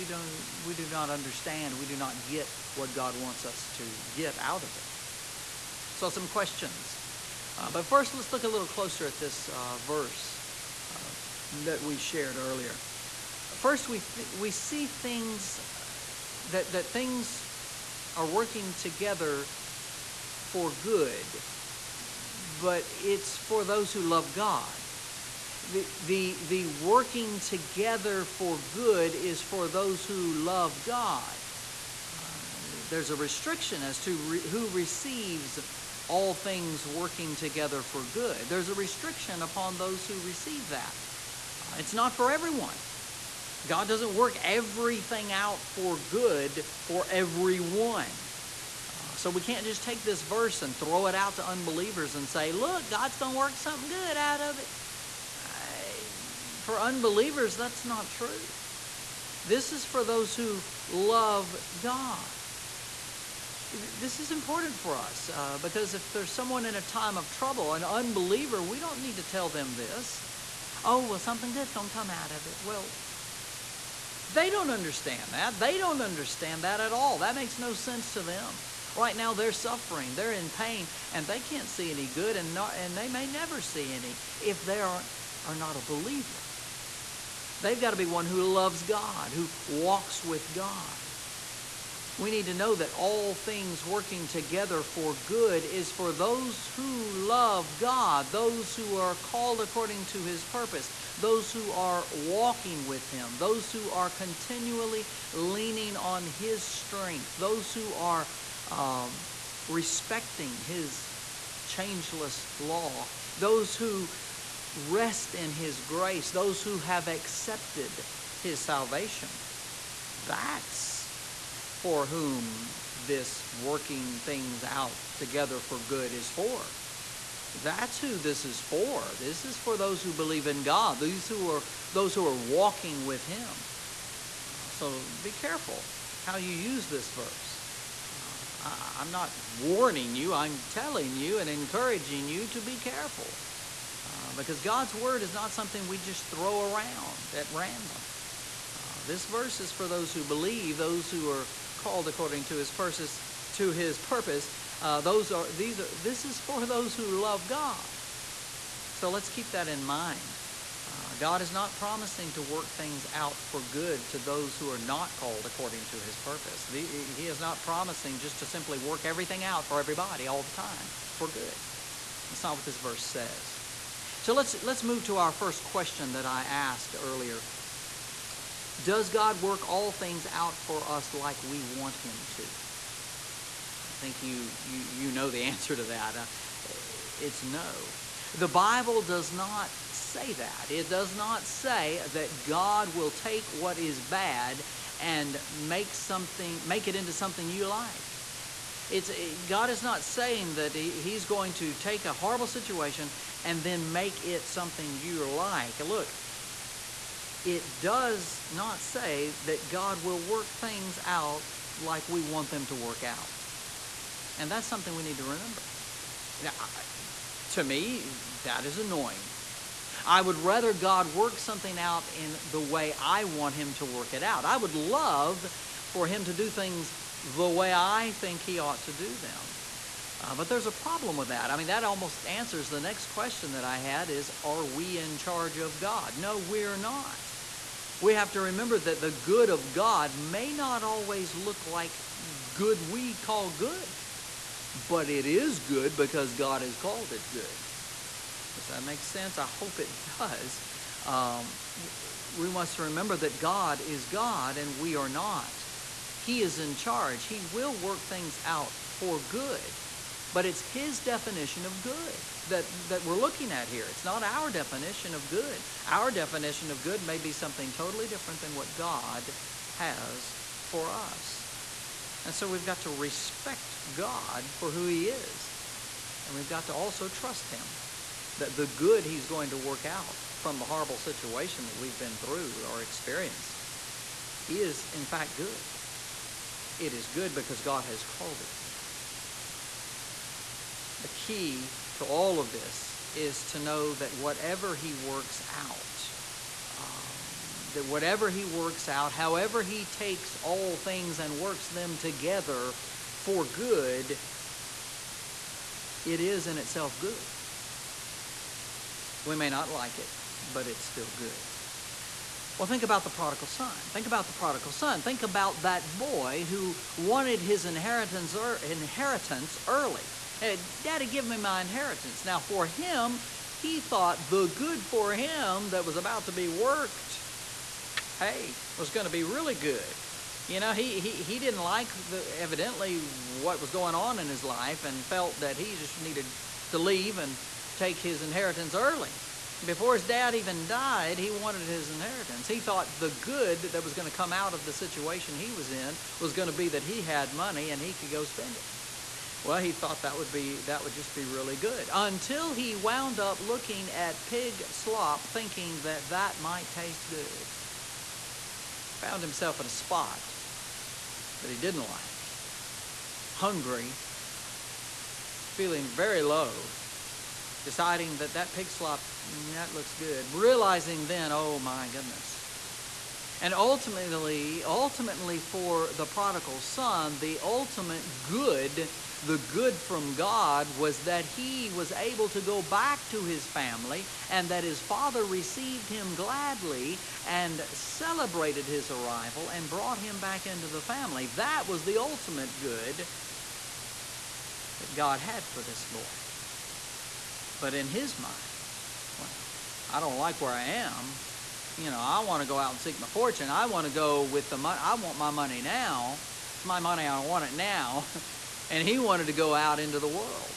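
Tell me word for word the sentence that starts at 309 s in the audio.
We may not like it, but it's still good.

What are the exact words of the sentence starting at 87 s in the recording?
They've got to be one who loves God, who walks with God.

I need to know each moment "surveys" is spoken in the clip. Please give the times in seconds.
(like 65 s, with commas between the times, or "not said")
not said.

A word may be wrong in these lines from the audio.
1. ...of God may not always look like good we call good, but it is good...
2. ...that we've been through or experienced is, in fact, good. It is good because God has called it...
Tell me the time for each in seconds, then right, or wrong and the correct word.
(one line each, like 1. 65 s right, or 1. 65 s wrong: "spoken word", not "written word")
1. 239 s right
2. 281 s right.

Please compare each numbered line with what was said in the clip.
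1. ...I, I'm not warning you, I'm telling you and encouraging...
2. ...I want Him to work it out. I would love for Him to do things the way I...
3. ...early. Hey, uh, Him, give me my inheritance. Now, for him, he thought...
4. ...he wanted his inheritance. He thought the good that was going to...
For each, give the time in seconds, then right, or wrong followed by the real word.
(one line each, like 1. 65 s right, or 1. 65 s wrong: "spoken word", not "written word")
1. 138 s right
2. 222 s right
3. 319 s wrong: "Daddy", not "Him"
4. 341 s right.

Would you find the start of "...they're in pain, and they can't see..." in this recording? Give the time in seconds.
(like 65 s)
80 s.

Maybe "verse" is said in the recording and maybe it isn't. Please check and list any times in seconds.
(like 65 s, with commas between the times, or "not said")
9 s, 50 s, 137 s, 149 s, 172 s.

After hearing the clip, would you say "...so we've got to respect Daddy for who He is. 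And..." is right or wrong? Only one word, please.
wrong.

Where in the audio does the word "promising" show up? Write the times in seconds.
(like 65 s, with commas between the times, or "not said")
161 s, 167 s.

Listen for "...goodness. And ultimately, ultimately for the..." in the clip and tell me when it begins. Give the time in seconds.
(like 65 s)
371 s.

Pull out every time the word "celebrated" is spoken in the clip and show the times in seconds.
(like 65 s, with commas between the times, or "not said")
387 s.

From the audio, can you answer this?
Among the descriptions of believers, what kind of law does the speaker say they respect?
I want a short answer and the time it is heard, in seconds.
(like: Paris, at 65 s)
His changeless law, at 111 s.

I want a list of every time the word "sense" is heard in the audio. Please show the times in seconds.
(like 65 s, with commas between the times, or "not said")
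77 s, 249 s.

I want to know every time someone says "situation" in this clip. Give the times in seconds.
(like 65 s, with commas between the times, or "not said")
202 s, 280 s, 344 s.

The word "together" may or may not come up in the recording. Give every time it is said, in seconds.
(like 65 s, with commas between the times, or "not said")
18 s, 27 s, 37 s, 94 s, 125 s, 301 s.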